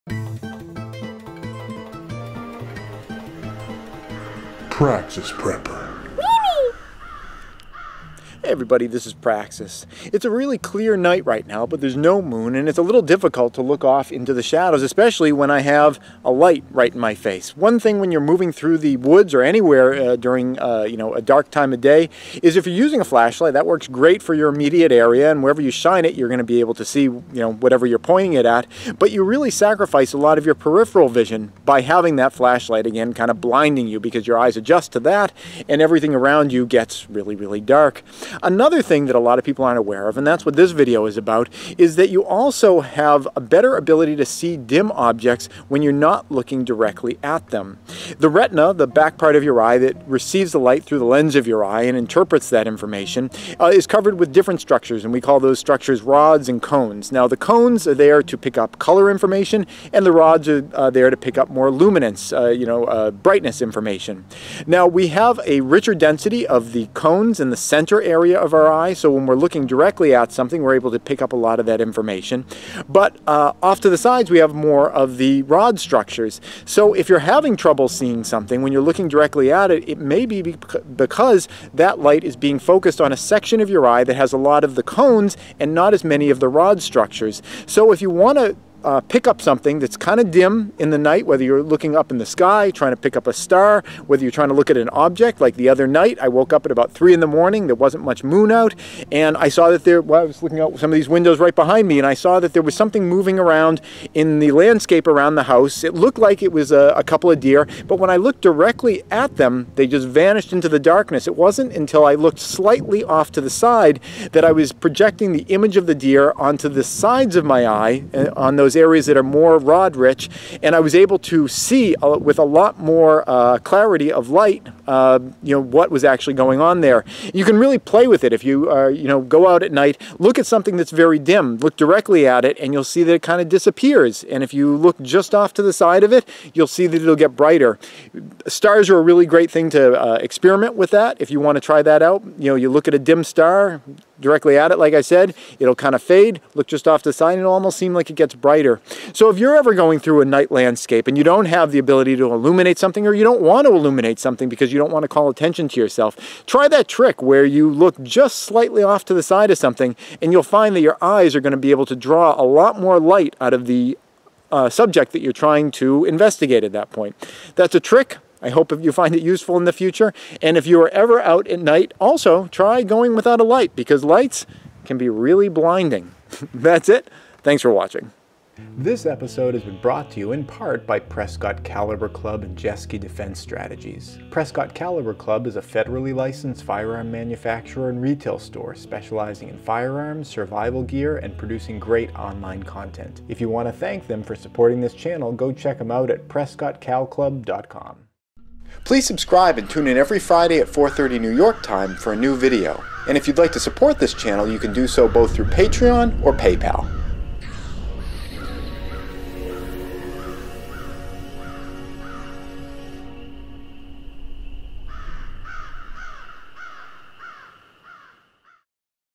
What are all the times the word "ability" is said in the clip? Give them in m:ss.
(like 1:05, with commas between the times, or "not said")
0:43, 2:31.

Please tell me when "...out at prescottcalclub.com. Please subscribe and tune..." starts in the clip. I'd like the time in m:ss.
3:15.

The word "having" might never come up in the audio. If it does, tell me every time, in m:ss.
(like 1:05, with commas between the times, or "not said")
0:31, 1:17.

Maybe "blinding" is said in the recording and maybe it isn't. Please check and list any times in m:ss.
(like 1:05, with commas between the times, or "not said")
0:33, 2:55.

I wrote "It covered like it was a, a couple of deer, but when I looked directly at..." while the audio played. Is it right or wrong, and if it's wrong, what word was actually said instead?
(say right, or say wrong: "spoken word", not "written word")
wrong: "looked", not "covered".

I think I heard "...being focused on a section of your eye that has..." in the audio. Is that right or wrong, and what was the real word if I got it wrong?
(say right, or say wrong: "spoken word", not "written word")
right.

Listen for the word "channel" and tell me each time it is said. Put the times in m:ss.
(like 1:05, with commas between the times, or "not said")
3:14, 3:24.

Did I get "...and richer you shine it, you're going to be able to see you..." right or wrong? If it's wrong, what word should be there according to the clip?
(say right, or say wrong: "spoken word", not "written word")
wrong: "wherever", not "richer".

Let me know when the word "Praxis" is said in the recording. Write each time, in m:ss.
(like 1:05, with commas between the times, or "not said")
0:04, 0:09.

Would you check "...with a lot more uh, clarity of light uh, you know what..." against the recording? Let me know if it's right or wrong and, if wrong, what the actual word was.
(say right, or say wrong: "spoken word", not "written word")
right.